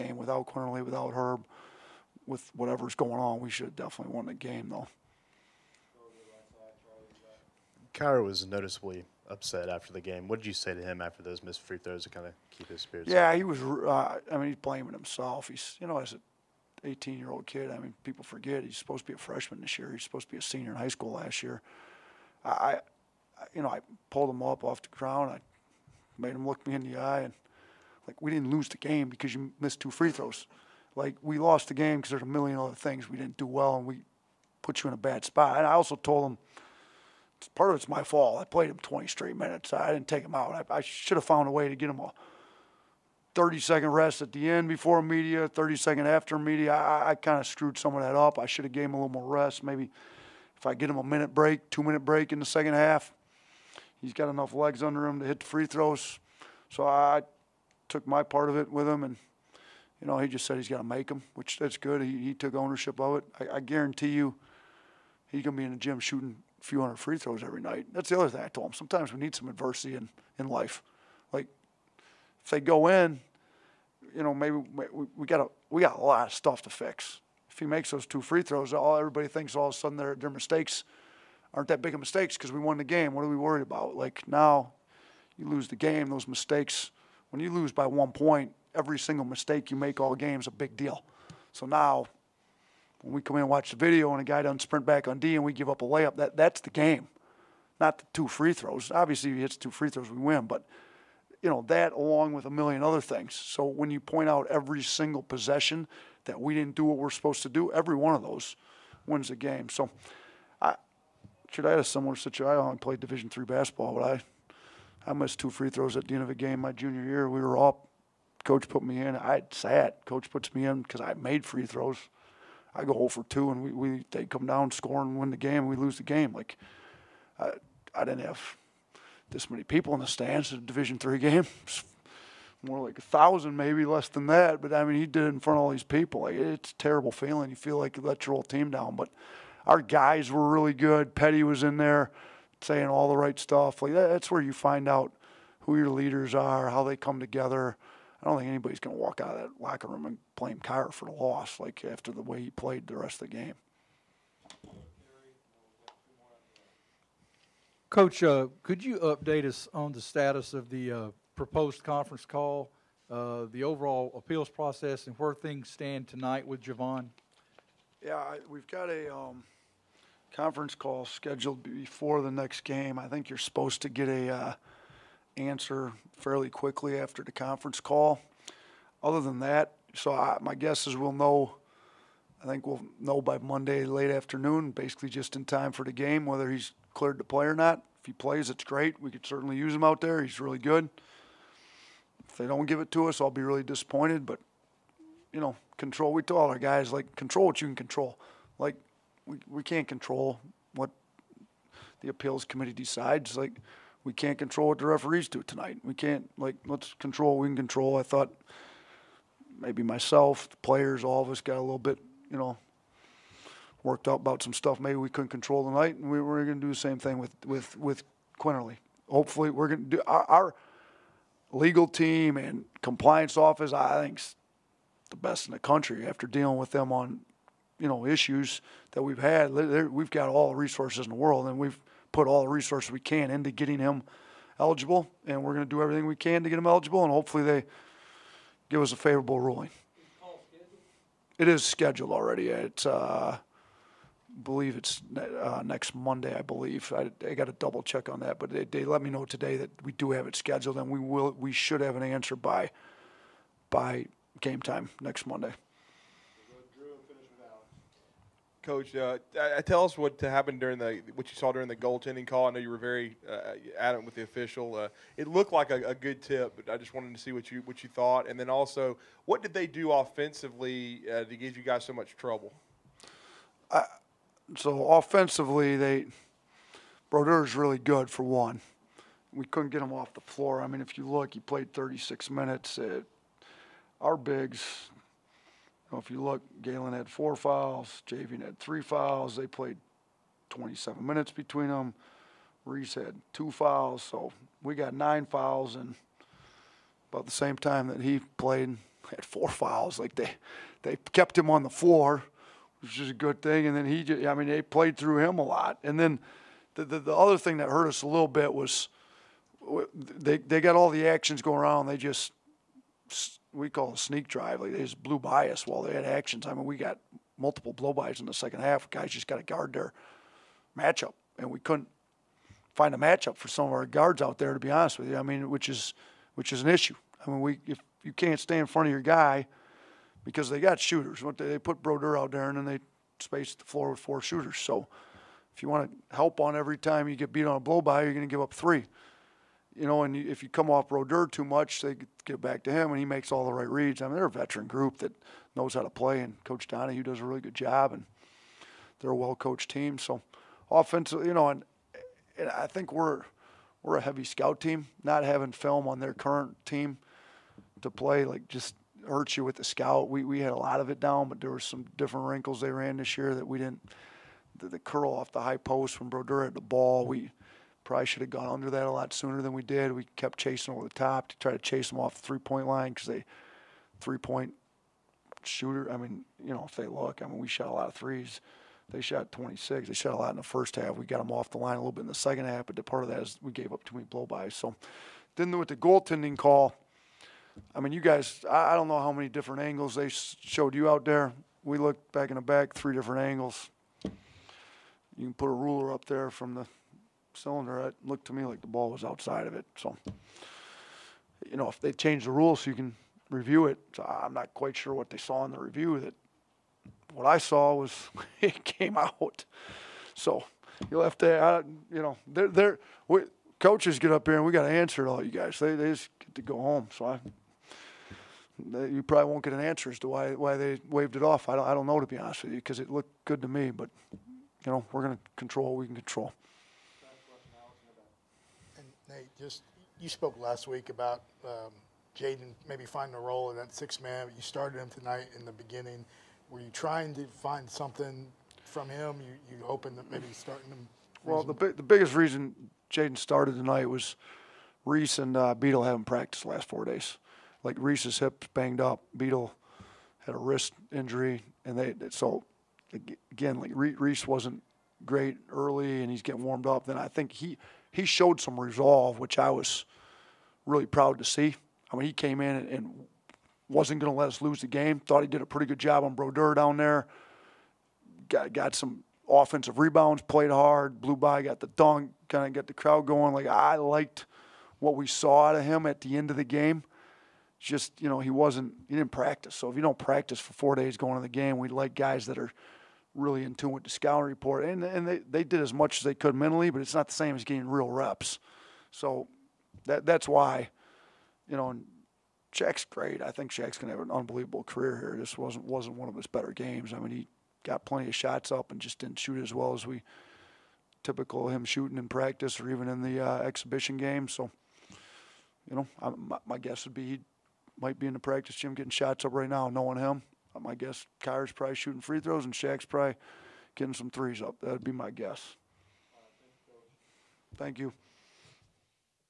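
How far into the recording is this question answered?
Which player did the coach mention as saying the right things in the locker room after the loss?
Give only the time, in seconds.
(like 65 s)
141 s.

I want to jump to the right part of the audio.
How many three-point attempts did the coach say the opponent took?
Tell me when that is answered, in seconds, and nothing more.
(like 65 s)
379 s.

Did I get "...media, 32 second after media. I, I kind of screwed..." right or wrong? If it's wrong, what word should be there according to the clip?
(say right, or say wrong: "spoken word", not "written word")
wrong: "30", not "32".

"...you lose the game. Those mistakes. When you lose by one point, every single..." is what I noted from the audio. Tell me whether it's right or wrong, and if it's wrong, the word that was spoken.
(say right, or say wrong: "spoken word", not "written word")
right.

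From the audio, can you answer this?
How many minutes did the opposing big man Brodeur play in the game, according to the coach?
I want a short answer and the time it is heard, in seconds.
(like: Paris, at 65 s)
36, at 281 s.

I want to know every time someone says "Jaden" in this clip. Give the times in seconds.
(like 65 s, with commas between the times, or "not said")
432 s, 442 s.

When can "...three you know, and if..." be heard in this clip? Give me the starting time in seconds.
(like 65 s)
338 s.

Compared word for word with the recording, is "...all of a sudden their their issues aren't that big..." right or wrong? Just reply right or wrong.
wrong.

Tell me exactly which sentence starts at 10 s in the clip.
What did you say to him after those missed free throws to kind of keep his spirits?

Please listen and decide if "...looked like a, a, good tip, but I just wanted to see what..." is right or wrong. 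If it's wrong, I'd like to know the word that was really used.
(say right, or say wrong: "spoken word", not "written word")
right.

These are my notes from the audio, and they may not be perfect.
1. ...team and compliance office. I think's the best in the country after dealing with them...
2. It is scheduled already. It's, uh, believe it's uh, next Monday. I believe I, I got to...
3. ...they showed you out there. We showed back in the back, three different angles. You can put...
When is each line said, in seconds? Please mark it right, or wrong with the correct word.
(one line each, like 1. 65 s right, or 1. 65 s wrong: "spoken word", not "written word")
1. 221 s right
2. 241 s right
3. 389 s wrong: "looked", not "showed".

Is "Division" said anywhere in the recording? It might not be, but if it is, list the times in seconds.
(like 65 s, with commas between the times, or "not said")
112 s, 130 s.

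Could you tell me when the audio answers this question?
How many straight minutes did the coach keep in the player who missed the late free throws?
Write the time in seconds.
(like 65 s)
38 s.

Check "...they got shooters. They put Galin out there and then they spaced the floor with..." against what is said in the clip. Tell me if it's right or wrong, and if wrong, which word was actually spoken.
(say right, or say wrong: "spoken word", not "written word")
wrong: "Brodeur", not "Galin".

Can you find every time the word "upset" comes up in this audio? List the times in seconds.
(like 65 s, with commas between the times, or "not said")
9 s.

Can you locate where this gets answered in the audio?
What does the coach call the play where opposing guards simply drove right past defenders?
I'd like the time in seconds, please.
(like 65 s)
313 s.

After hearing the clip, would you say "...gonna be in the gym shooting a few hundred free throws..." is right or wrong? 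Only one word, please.
right.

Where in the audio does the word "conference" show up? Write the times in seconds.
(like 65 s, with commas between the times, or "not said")
161 s, 170 s, 177 s.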